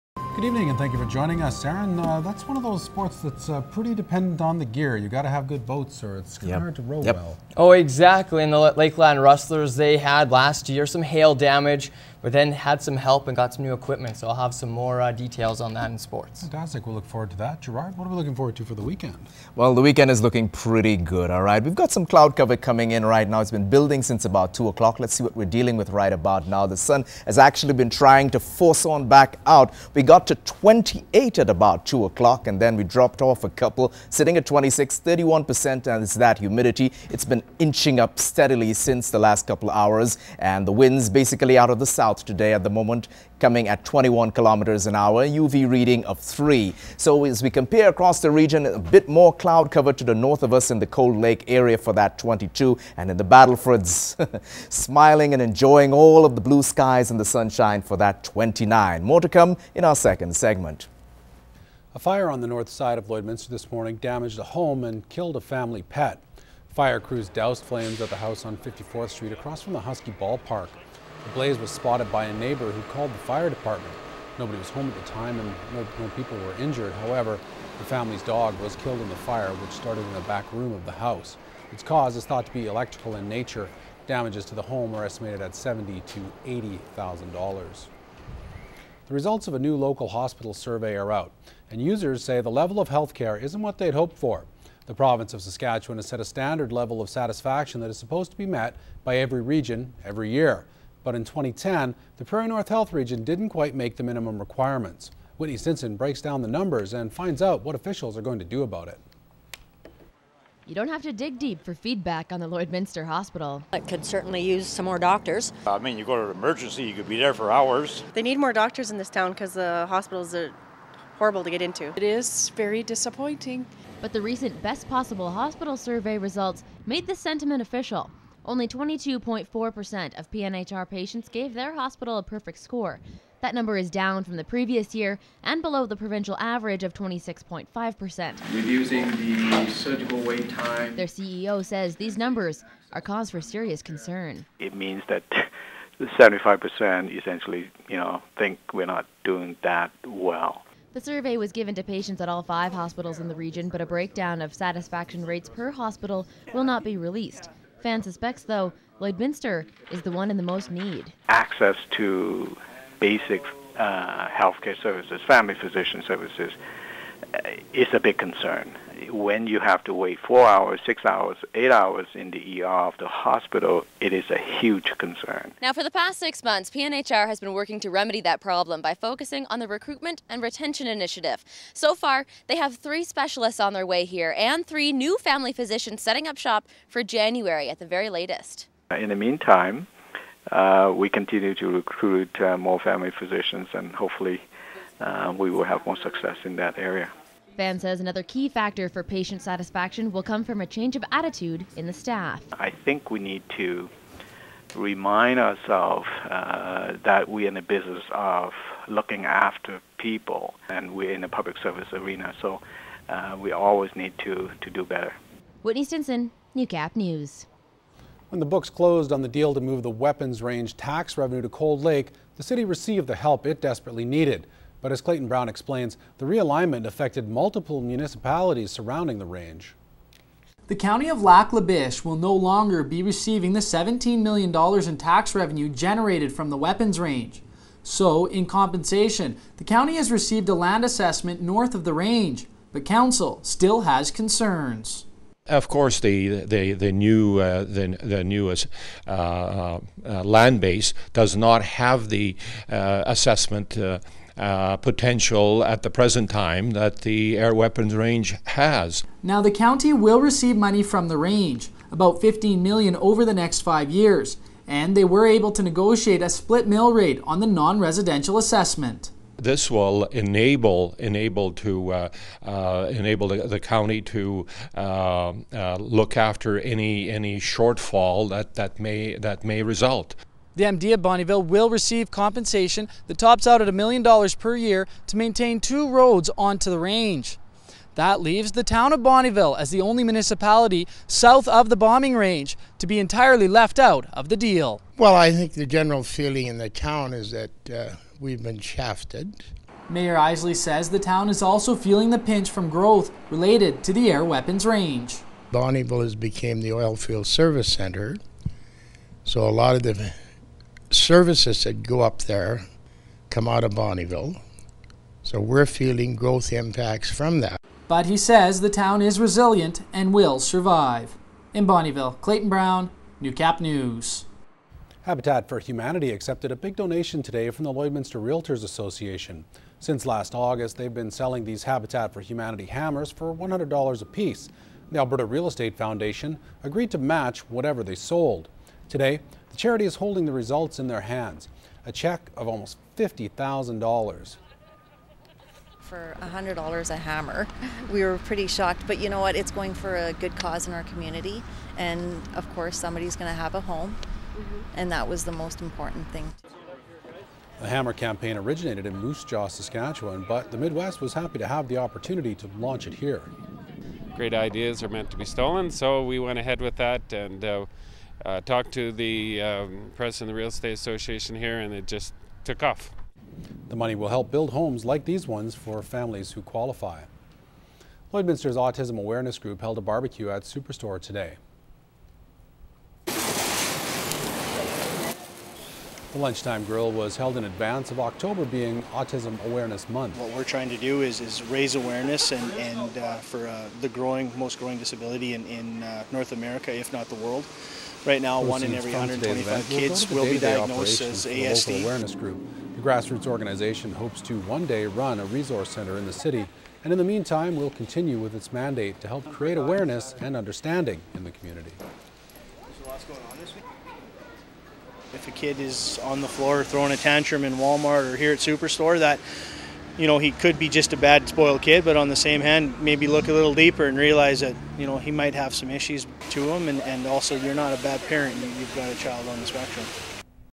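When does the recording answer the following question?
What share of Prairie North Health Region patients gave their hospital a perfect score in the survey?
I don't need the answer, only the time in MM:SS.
02:08.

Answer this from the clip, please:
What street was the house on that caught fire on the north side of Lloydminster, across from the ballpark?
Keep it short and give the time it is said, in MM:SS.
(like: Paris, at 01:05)
54th Street, at 01:08.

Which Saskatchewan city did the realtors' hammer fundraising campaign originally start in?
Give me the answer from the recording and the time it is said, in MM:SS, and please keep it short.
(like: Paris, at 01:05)
Moose Jaw, at 05:58.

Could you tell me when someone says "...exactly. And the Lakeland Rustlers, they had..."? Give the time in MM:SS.
00:07.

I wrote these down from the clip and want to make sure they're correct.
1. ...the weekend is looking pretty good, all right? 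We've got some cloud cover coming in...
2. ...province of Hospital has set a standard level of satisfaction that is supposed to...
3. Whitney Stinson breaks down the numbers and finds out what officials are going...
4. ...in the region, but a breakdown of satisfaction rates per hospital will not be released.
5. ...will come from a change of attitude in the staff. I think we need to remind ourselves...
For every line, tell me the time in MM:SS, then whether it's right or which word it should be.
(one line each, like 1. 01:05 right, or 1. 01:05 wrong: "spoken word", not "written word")
1. 00:19 right
2. 01:34 wrong: "Saskatchewan", not "Hospital"
3. 01:45 right
4. 02:33 right
5. 03:20 right.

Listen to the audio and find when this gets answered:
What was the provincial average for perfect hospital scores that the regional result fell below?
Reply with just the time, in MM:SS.
02:16.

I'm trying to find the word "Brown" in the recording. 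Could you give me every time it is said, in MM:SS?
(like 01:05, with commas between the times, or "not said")
03:45, 05:22.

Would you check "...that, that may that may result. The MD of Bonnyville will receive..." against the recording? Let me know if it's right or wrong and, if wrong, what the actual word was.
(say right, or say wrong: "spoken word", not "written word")
right.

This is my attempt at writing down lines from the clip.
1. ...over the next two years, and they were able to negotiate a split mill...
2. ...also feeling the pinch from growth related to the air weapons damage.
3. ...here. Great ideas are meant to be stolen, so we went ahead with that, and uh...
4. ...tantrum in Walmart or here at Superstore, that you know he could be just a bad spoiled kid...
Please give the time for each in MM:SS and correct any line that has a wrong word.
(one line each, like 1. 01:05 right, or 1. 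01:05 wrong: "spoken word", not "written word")
1. 04:22 wrong: "five", not "two"
2. 05:01 wrong: "range", not "damage"
3. 06:02 right
4. 06:56 right.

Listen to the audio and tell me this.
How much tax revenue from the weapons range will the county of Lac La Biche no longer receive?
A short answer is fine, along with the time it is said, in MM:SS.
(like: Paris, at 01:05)
$17 million, at 03:53.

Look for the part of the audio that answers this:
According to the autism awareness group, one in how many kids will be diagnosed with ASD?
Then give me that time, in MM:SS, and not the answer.
06:38.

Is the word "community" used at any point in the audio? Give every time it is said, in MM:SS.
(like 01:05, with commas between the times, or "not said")
05:50, 06:51.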